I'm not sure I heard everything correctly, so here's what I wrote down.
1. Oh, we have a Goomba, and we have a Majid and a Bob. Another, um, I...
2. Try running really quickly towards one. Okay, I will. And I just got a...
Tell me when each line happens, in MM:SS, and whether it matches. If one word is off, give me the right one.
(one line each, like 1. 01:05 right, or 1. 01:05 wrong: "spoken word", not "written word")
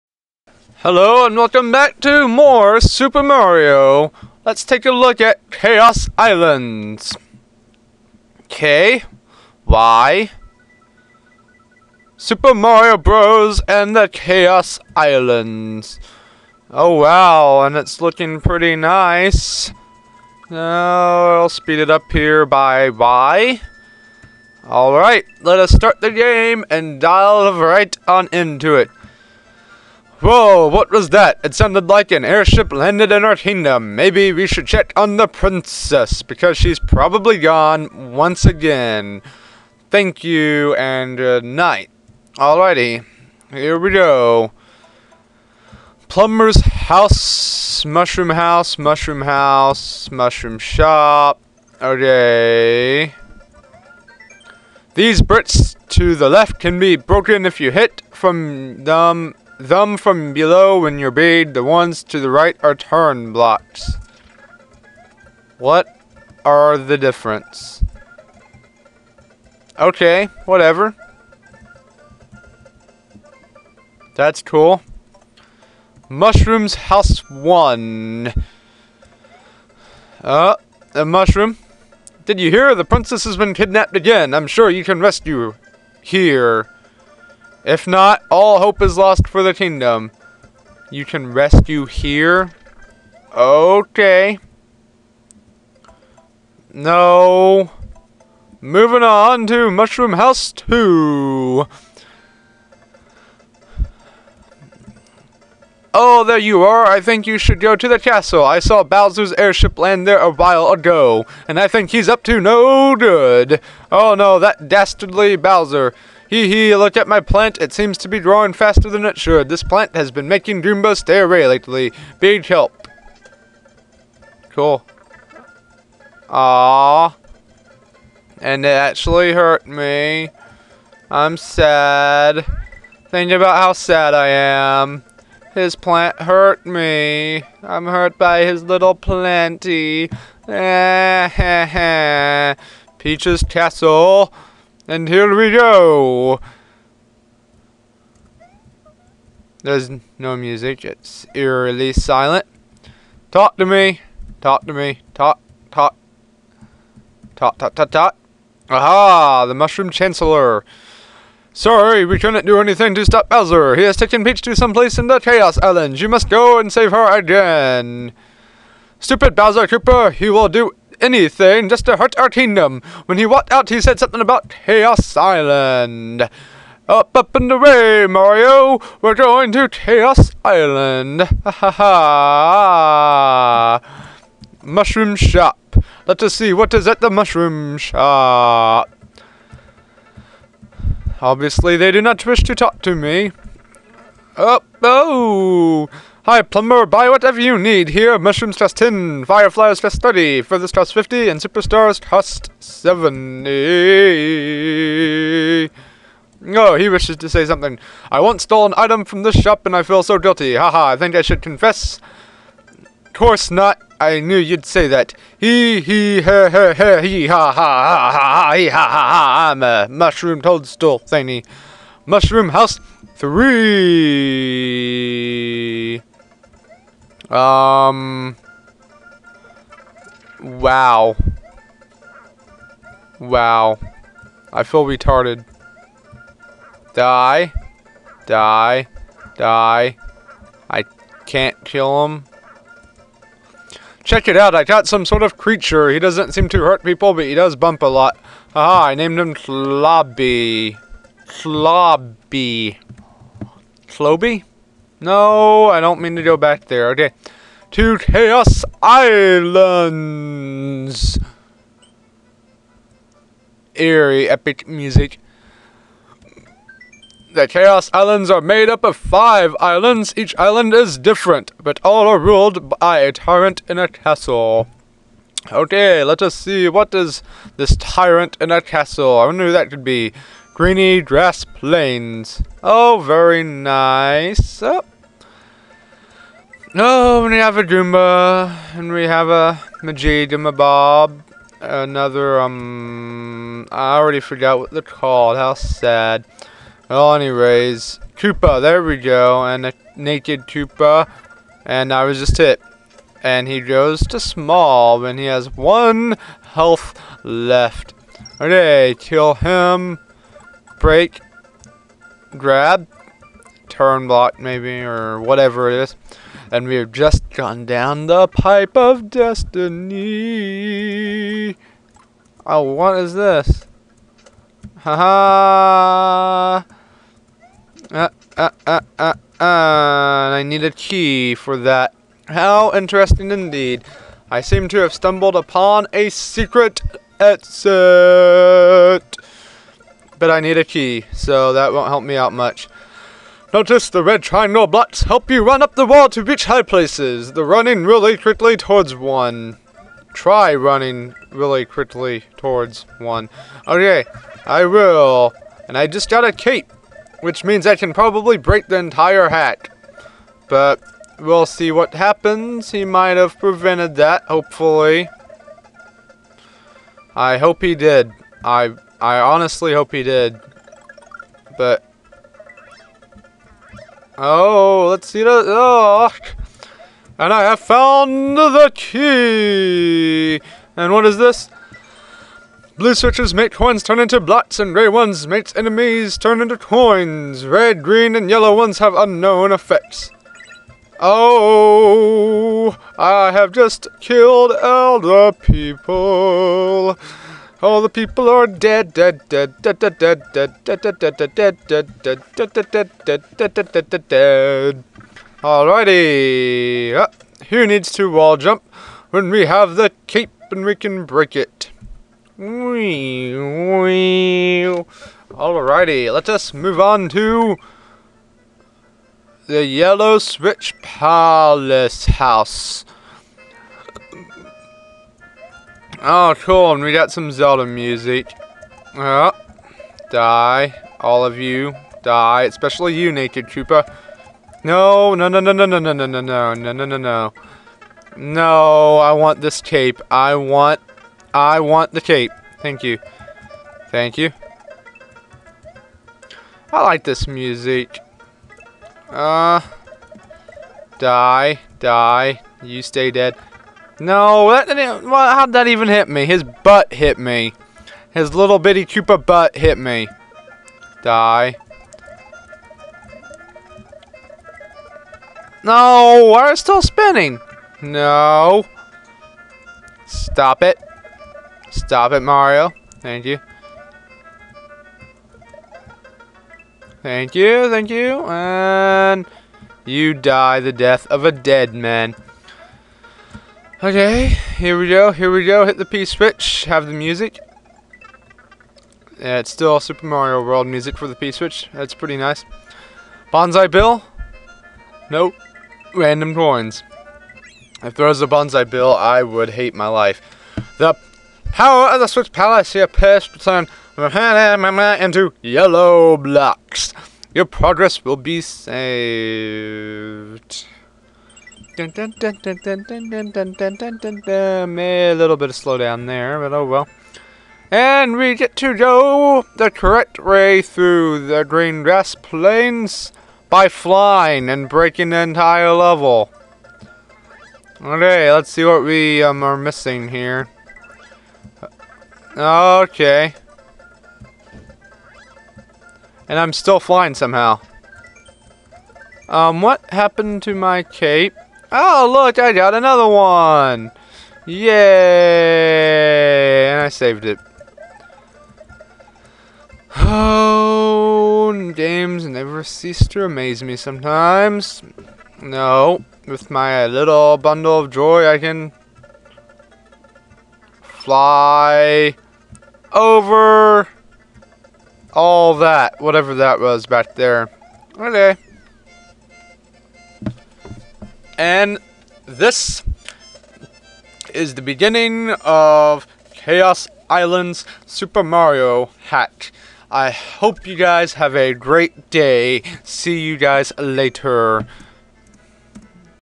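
1. 04:46 right
2. 05:50 right.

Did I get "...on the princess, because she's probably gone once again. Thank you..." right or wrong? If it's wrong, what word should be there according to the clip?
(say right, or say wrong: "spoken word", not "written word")
right.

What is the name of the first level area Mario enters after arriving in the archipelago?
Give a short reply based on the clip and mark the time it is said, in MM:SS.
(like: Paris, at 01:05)
Greeny Dress Plains, at 04:40.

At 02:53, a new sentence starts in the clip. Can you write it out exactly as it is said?
When he walked out, he said something about Kaos Island.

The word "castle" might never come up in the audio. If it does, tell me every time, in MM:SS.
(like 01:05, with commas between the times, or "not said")
01:47, 02:23, 04:33, 04:38.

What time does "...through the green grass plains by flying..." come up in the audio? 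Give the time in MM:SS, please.
08:40.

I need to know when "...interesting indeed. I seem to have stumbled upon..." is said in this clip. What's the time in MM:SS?
05:32.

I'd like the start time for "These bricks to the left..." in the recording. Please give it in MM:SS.
00:54.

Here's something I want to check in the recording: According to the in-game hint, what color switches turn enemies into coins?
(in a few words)
Grey.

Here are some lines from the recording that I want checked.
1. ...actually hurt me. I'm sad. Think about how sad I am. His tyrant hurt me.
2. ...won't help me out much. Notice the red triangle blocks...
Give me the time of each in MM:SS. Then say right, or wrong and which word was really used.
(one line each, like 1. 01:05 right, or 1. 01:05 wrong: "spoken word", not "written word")
1. 02:08 wrong: "plant", not "tyrant"
2. 05:41 right.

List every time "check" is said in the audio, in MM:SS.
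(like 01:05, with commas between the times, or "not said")
00:34, 04:04.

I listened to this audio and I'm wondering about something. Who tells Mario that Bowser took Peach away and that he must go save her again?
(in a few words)
The Mushroom Chancellor.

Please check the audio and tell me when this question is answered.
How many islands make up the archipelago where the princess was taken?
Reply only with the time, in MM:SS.
04:28.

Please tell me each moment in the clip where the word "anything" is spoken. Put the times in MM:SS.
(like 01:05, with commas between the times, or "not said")
02:42, 02:51.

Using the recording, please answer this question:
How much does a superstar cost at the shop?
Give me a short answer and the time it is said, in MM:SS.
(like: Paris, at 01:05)
70, at 03:21.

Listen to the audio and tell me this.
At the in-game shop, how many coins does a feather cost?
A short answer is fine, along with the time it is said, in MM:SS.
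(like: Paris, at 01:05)
50, at 03:20.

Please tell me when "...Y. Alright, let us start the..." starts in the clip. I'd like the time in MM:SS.
00:22.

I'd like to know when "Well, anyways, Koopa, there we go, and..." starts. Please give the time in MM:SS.
04:56.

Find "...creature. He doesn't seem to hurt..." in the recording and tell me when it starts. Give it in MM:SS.
04:05.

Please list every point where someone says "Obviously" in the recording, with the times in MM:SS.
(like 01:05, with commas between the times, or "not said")
03:11.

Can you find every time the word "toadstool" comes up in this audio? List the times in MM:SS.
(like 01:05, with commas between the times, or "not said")
03:40.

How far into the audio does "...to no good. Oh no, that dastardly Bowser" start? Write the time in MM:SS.
01:52.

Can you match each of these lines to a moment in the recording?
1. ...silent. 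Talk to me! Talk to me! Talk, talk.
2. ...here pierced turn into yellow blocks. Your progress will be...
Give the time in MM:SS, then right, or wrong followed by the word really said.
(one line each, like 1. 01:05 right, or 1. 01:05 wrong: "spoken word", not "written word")
1. 02:31 right
2. 08:22 right.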